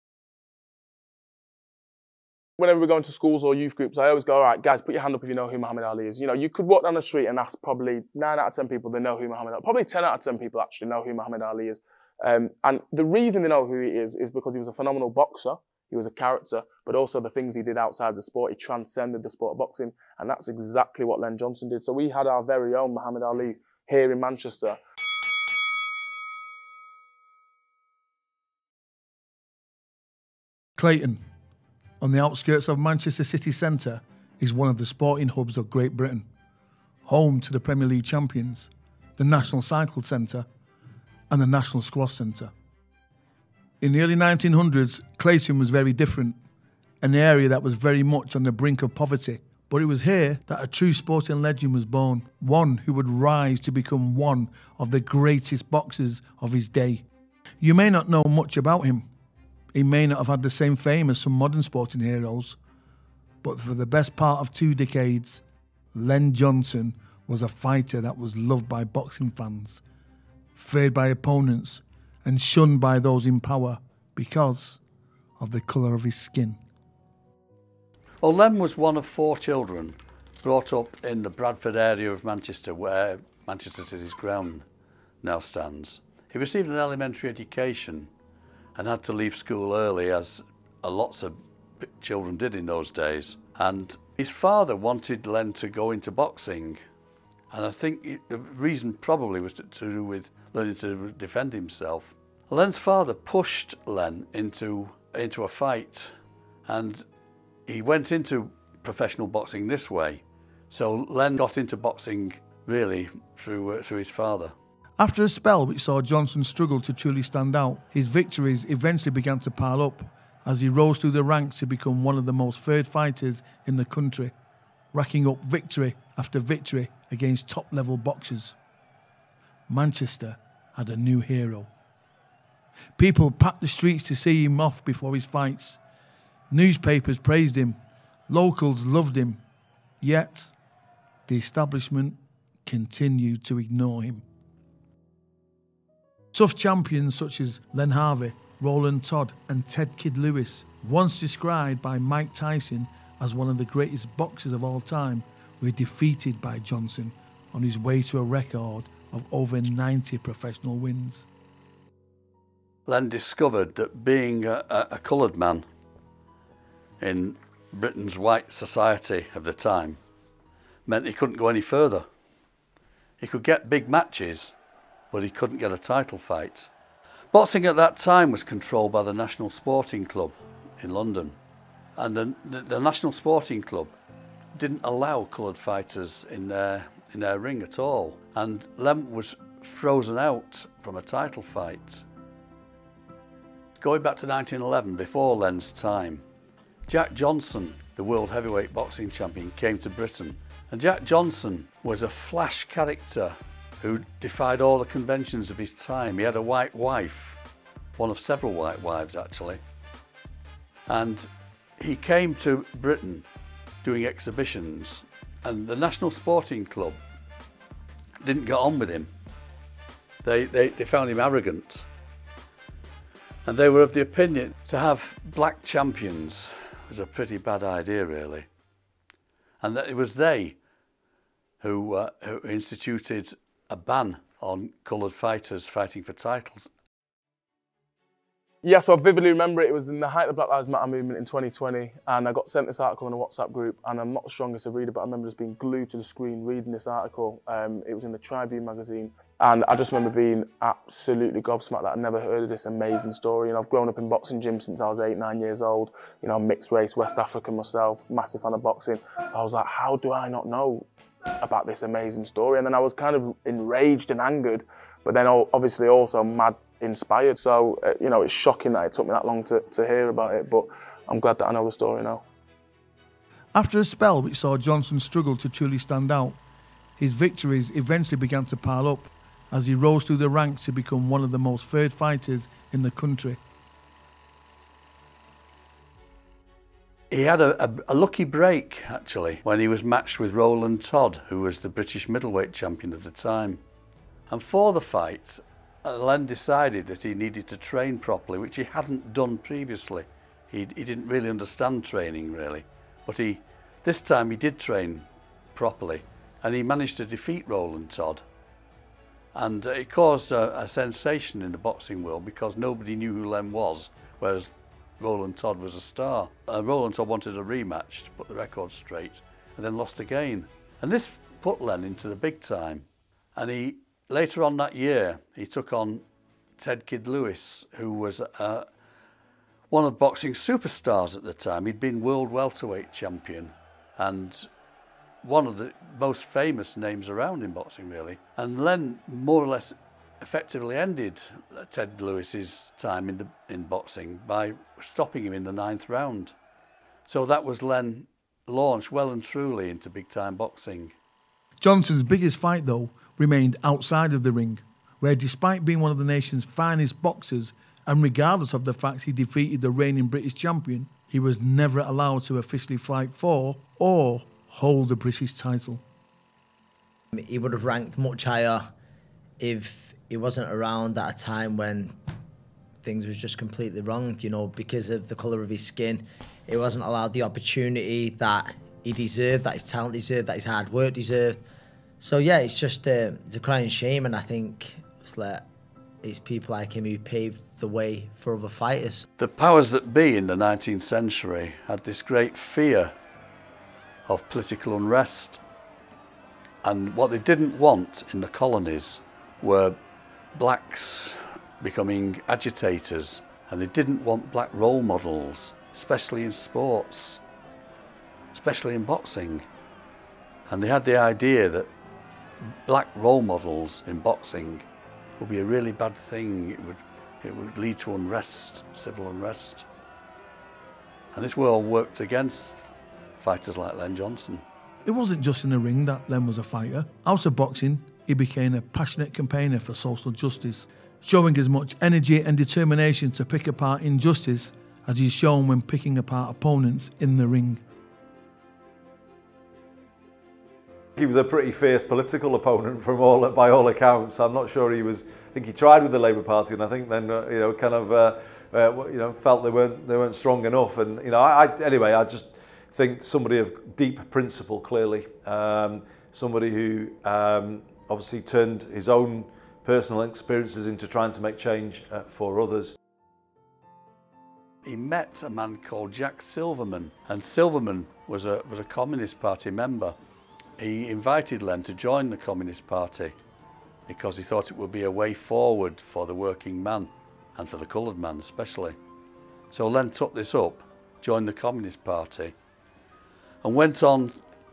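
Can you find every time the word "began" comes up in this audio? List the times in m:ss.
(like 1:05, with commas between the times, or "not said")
1:59, 4:38.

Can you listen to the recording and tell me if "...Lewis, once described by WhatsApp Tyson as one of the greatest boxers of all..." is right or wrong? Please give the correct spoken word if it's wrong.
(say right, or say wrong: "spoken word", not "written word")
wrong: "Mike", not "WhatsApp".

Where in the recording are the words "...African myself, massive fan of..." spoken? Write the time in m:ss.
4:17.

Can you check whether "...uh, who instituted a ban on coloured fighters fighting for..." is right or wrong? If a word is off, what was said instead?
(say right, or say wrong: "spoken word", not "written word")
right.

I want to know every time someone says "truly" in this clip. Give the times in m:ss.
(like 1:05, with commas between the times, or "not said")
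1:56, 4:35, 5:49.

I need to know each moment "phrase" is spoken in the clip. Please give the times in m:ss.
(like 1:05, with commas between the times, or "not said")
not said.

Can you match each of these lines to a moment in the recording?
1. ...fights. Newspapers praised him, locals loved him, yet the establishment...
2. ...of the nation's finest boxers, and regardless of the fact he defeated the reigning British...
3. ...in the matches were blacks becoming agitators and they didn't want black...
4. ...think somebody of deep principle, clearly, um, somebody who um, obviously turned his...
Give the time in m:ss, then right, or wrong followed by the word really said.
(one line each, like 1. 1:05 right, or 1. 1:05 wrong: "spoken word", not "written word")
1. 2:15 right
2. 5:55 right
3. 6:38 wrong: "colonies", not "matches"
4. 7:32 right.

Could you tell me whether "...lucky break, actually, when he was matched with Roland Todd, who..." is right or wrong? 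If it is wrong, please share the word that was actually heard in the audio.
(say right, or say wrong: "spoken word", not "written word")
right.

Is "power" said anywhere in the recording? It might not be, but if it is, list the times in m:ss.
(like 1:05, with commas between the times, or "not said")
1:13, 6:29.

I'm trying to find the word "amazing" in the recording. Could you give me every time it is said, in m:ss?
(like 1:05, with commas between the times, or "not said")
4:12, 4:21.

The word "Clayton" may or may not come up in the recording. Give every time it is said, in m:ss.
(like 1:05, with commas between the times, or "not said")
0:30, 0:45.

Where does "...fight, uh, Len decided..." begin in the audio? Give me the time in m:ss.
4:54.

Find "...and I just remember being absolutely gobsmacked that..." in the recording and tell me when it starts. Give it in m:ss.
4:09.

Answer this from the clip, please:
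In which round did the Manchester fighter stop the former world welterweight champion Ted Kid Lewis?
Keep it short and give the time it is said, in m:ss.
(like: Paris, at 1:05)
Ninth, at 5:45.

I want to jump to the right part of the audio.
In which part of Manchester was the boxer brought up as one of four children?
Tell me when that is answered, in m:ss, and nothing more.
1:21.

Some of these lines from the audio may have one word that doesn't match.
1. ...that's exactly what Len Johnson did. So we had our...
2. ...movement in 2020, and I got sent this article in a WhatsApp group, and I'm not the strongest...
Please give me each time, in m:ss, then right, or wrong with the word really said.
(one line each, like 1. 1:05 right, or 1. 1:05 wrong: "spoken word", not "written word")
1. 0:20 right
2. 4:00 right.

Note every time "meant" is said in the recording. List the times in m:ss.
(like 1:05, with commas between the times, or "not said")
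2:50.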